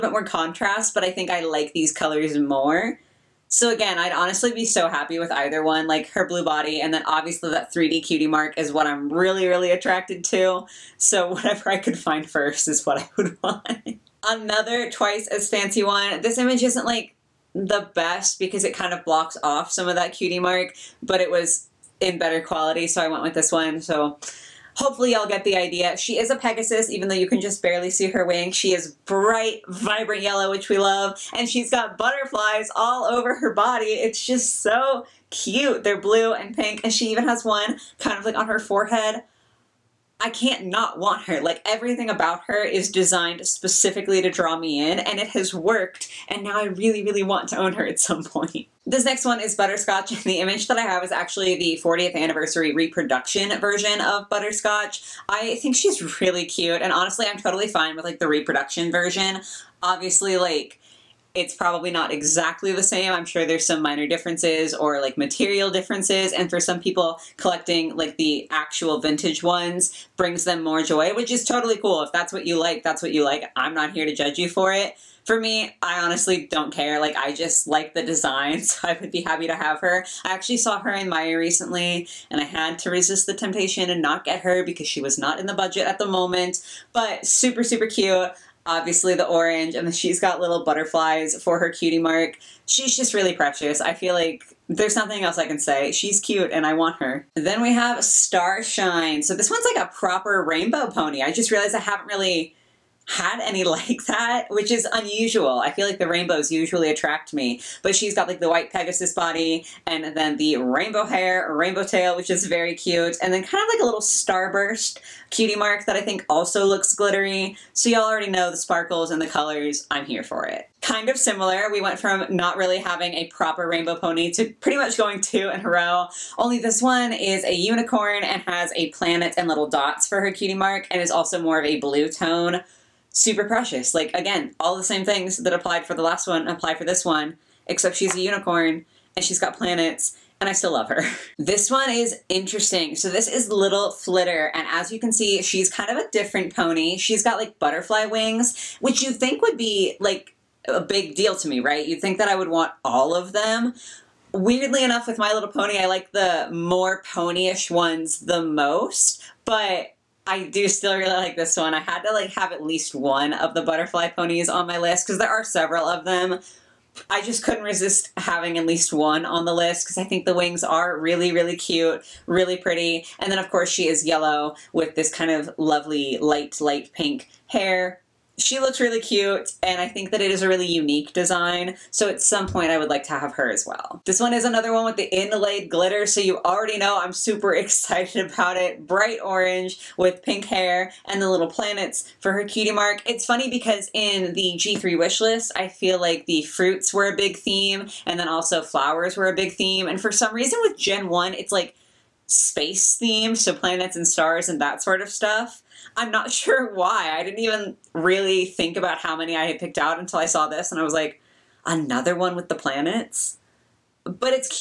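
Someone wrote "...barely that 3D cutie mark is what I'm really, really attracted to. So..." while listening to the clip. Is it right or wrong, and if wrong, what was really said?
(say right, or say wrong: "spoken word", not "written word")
wrong: "obviously", not "barely".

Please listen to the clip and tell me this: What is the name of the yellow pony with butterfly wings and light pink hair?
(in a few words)
Little Flitter.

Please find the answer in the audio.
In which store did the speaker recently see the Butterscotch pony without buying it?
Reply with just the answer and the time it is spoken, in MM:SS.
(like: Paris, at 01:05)
Meijer, at 01:21.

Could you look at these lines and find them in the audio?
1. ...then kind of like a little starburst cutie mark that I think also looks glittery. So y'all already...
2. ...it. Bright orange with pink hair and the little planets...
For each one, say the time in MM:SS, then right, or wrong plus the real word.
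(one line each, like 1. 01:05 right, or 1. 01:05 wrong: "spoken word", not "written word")
1. 01:53 right
2. 03:08 right.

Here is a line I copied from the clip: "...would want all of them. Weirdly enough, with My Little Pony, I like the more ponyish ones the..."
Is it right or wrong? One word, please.
right.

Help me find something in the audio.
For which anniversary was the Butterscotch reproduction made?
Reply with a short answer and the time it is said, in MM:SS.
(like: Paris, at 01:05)
40th, at 00:51.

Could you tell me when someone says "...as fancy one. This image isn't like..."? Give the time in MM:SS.
00:15.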